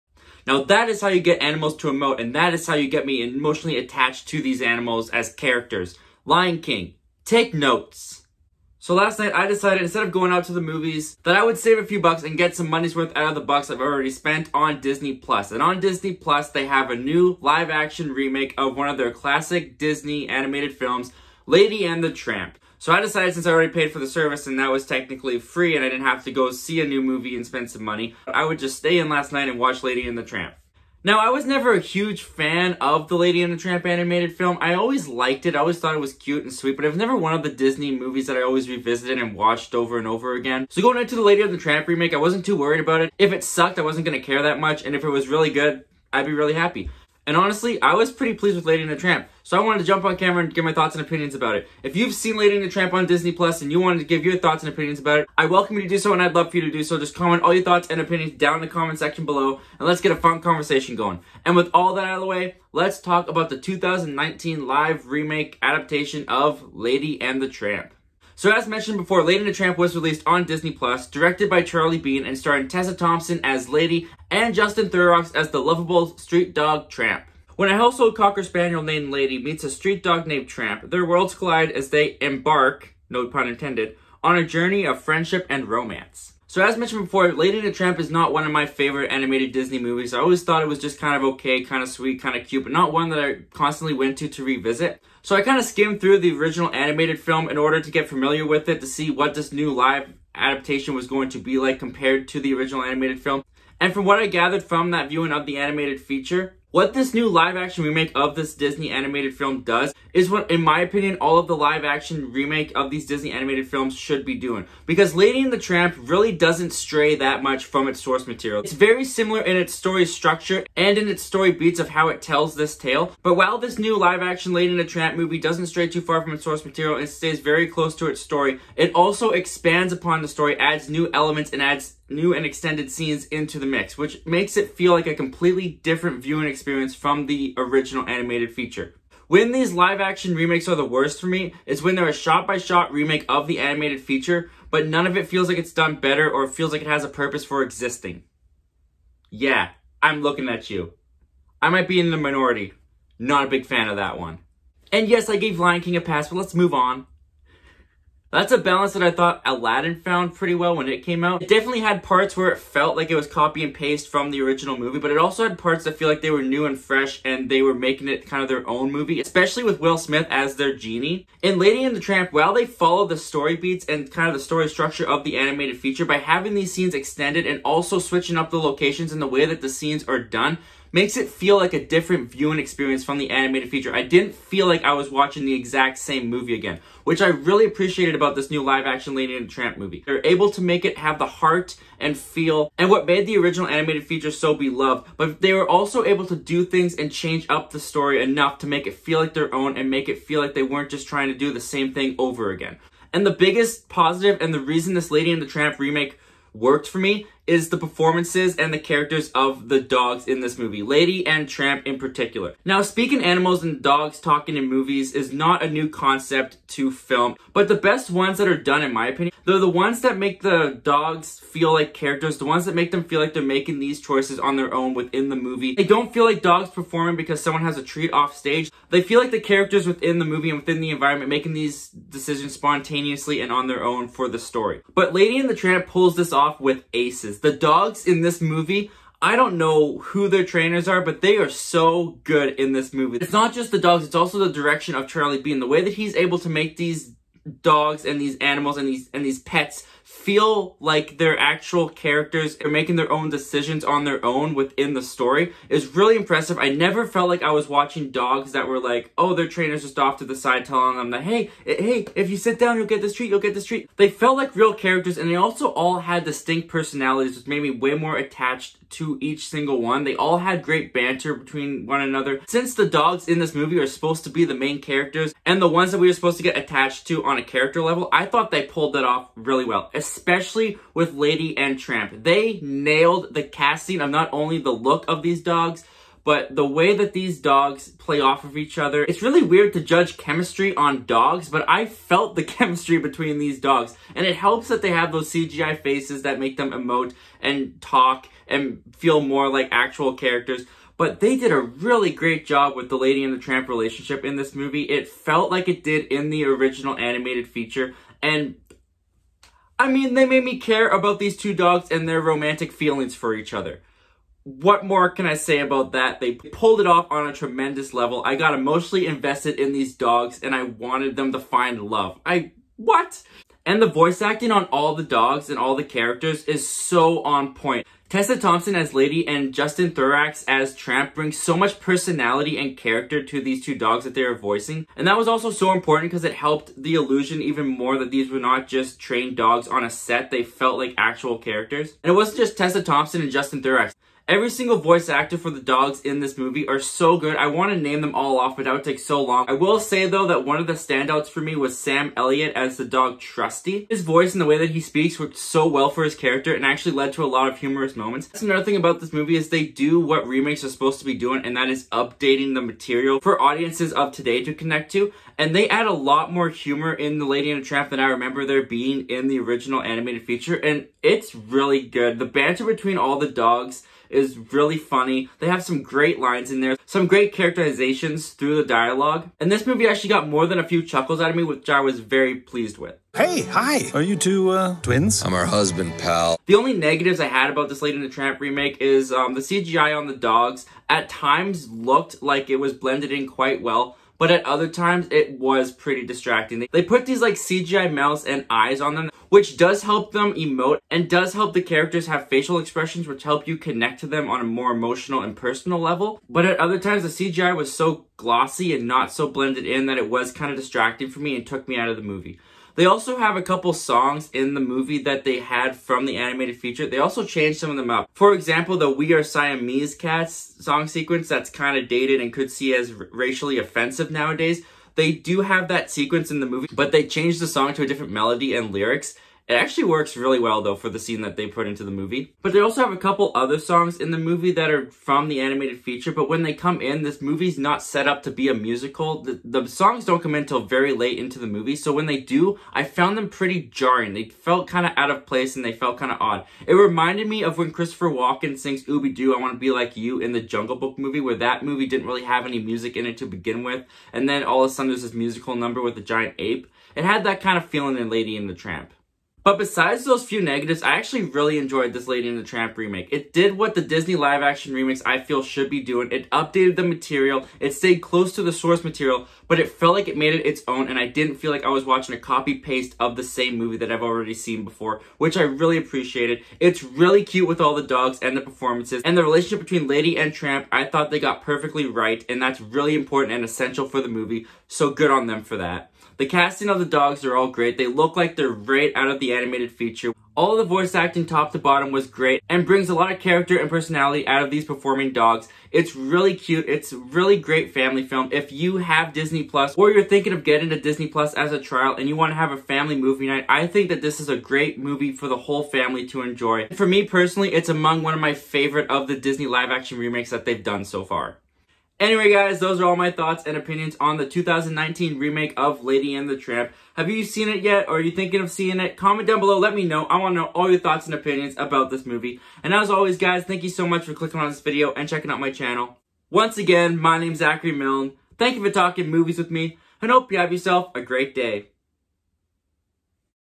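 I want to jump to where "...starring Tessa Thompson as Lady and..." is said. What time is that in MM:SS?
01:12.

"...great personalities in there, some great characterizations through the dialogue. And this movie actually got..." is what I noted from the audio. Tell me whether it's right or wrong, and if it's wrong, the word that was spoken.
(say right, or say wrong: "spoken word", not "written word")
wrong: "lines", not "personalities".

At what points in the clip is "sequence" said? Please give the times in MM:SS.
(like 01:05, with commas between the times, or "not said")
07:00, 07:05.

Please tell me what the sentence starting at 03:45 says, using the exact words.
They don't feel like dogs performing because someone has a treat off stage.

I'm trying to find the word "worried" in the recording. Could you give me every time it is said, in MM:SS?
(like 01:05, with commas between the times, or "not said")
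00:42.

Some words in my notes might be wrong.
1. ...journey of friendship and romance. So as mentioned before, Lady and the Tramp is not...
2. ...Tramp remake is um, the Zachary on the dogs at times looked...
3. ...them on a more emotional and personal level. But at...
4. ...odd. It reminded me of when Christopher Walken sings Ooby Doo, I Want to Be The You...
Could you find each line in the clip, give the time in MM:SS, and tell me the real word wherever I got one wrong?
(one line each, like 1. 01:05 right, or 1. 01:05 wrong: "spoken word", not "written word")
1. 01:24 right
2. 06:28 wrong: "CGI", not "Zachary"
3. 06:44 right
4. 07:26 wrong: "Like", not "The".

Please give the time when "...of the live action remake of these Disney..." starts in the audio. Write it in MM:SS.
01:51.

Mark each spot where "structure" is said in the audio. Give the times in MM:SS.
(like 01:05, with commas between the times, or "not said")
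02:00, 02:54.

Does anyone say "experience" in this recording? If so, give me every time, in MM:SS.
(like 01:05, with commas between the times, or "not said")
02:16, 03:02.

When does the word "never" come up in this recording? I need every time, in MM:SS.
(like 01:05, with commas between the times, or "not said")
00:31, 00:36, 04:16.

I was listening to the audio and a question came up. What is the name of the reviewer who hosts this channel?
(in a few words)
Zachary Milne.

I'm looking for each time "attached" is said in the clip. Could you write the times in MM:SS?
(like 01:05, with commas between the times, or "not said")
00:03, 04:28, 04:36.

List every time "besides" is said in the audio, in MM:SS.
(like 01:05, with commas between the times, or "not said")
07:39.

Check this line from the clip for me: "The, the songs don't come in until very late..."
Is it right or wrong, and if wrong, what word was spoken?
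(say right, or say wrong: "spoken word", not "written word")
right.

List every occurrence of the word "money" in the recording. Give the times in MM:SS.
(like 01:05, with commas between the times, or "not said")
00:12, 00:27.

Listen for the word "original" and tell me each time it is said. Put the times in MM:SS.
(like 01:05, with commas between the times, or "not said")
01:36, 01:42, 02:17, 02:44, 03:13, 05:06, 06:09.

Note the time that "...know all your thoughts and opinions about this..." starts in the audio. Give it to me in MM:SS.
08:40.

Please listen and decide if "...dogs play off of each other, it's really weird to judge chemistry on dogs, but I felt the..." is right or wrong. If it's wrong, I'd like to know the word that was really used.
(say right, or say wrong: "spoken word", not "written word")
right.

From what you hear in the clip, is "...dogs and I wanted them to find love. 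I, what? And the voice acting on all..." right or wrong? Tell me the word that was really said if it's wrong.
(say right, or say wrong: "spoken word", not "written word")
right.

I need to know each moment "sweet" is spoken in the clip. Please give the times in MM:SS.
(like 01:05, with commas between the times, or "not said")
00:36, 01:31.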